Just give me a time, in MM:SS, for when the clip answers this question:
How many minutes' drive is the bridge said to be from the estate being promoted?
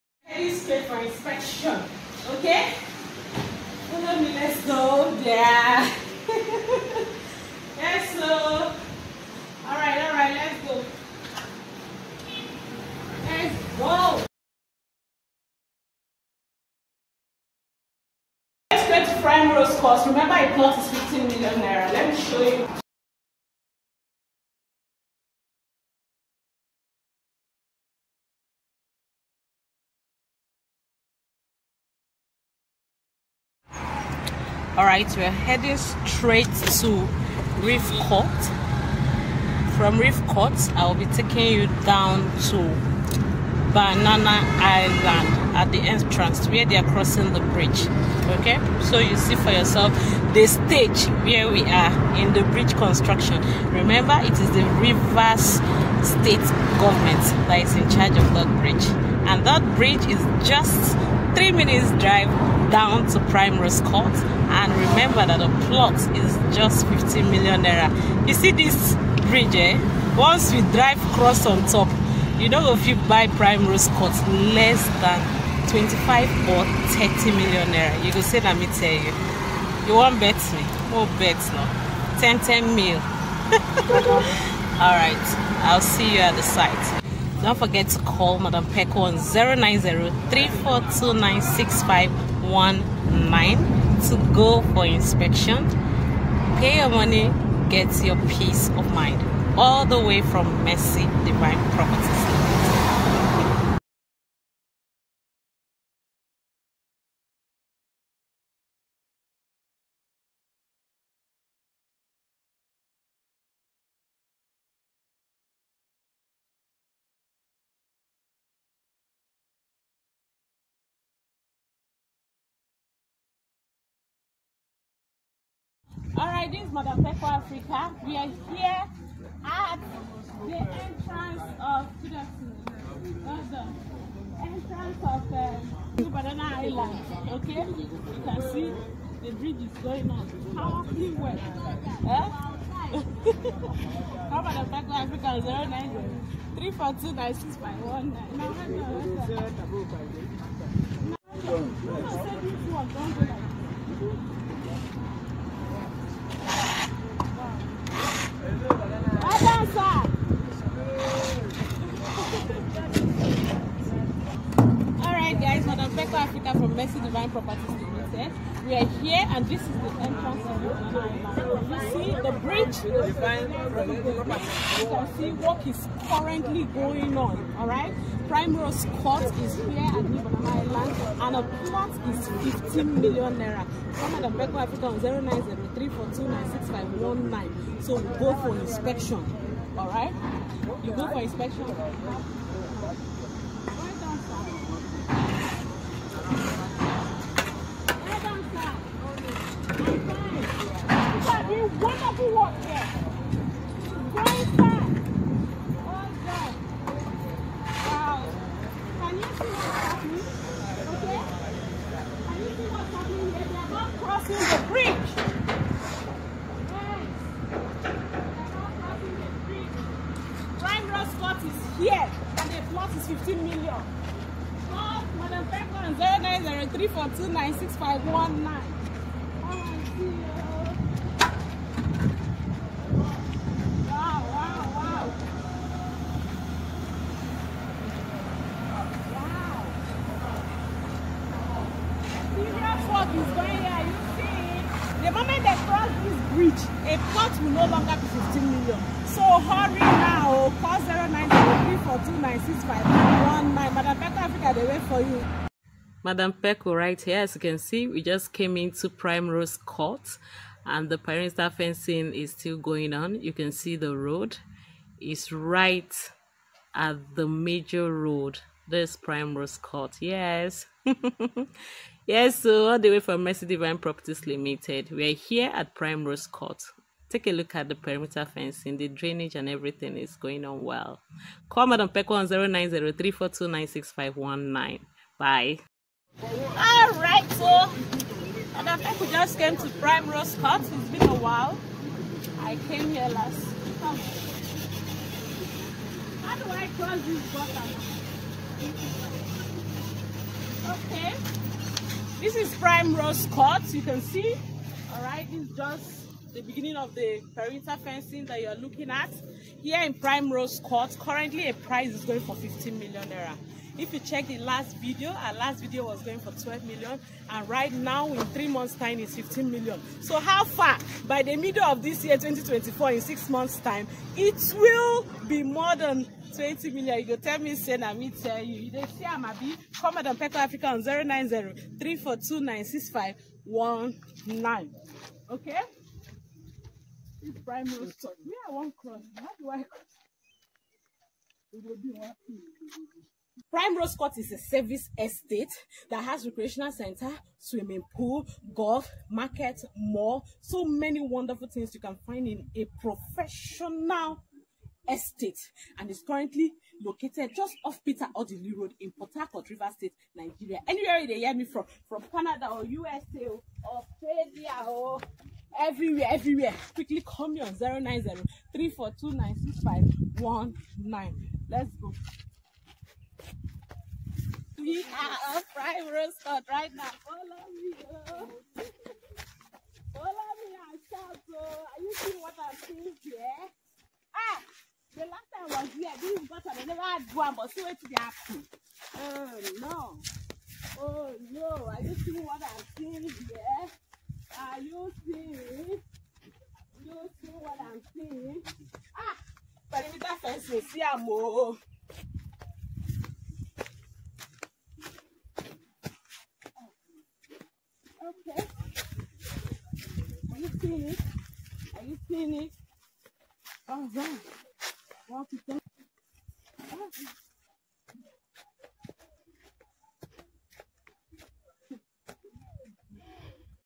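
01:01.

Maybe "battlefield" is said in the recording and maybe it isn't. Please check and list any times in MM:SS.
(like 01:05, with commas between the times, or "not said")
not said.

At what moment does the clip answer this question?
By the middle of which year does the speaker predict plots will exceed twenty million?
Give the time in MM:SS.
05:22.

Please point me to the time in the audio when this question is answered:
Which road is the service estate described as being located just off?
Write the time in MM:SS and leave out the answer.
05:57.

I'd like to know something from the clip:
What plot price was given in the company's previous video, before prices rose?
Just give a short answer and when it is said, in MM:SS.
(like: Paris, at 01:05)
12 million naira, at 05:16.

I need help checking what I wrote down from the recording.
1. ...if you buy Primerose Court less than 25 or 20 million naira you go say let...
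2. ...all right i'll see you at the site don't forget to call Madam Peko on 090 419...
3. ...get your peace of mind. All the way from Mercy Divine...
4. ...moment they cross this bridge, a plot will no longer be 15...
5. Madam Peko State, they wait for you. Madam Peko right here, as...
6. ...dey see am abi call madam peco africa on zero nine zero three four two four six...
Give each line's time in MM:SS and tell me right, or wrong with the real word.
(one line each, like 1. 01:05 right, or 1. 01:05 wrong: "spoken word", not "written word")
1. 01:12 wrong: "30", not "20"
2. 01:24 right
3. 01:37 right
4. 04:05 right
5. 04:13 wrong: "Africa", not "State"
6. 05:28 wrong: "nine", not "four".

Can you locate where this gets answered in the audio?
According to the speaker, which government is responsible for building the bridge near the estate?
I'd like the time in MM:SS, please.
00:54.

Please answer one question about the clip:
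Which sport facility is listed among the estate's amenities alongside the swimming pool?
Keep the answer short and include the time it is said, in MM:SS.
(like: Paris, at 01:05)
Golf, at 05:48.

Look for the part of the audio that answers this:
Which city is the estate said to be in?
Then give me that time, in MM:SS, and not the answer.
05:58.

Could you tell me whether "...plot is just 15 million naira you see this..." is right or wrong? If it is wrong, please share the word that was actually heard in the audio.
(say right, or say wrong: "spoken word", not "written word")
right.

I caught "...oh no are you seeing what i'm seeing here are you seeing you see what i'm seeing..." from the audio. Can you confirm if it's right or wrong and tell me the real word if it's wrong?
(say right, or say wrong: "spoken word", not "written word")
right.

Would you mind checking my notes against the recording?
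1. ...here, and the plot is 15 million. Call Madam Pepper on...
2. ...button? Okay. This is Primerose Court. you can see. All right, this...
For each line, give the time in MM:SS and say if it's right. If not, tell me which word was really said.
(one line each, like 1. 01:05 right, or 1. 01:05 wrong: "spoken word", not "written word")
1. 03:41 right
2. 04:57 right.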